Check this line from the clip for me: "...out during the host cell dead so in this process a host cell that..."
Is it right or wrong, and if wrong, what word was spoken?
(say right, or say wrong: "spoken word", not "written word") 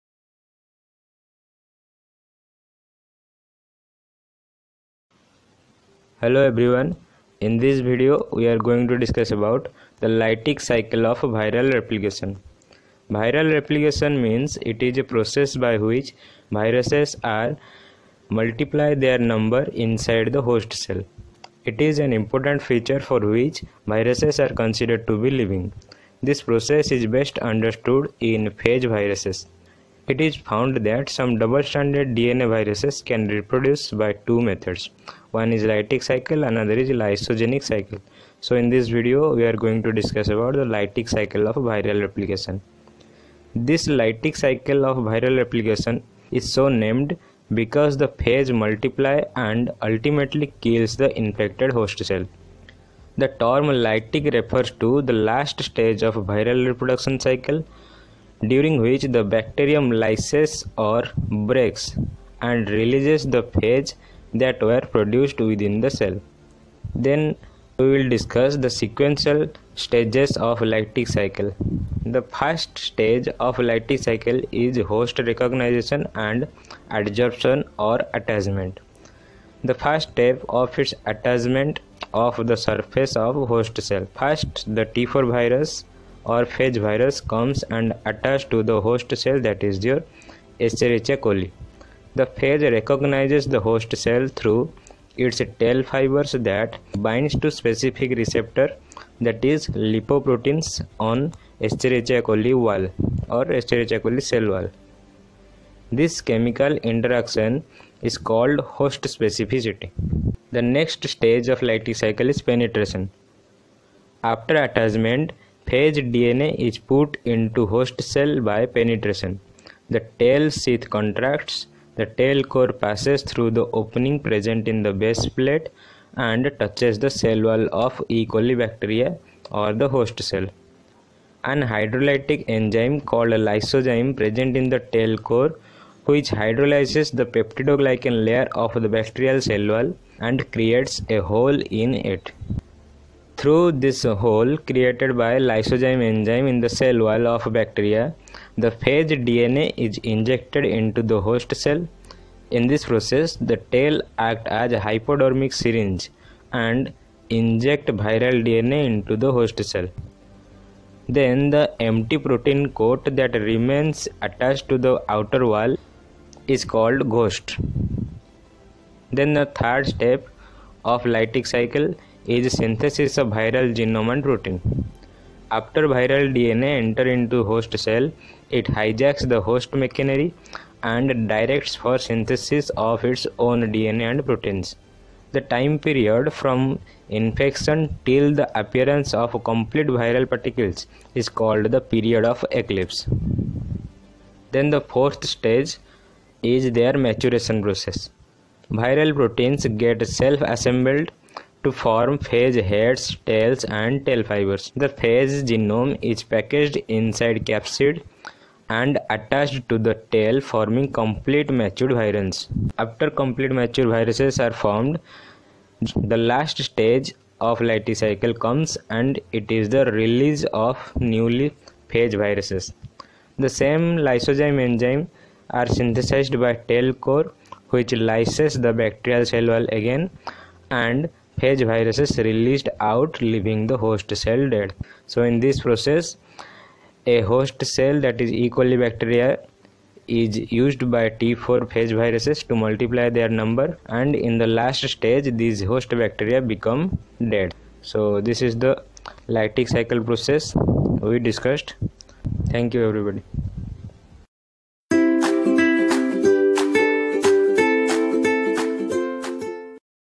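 wrong: "leaving", not "during".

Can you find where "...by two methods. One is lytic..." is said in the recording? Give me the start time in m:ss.
0:34.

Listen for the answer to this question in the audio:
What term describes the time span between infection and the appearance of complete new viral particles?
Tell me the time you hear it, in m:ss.
3:11.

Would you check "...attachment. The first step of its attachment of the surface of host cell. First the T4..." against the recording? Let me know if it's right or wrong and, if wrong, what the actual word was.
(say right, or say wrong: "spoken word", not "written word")
right.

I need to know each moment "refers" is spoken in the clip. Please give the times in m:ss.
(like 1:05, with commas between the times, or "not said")
0:54.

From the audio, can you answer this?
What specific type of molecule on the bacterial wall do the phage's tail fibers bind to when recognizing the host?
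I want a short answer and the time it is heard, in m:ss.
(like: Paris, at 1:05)
lipoproteins, at 1:39.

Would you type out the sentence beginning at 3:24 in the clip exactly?
The phage genome is packaged inside capsid and attached to the tail forming complete matured virus.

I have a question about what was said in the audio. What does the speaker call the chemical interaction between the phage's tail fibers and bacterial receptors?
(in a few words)
host specificity.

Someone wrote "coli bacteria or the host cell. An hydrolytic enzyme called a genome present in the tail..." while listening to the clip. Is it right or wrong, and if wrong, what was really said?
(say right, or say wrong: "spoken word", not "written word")
wrong: "lysozyme", not "genome".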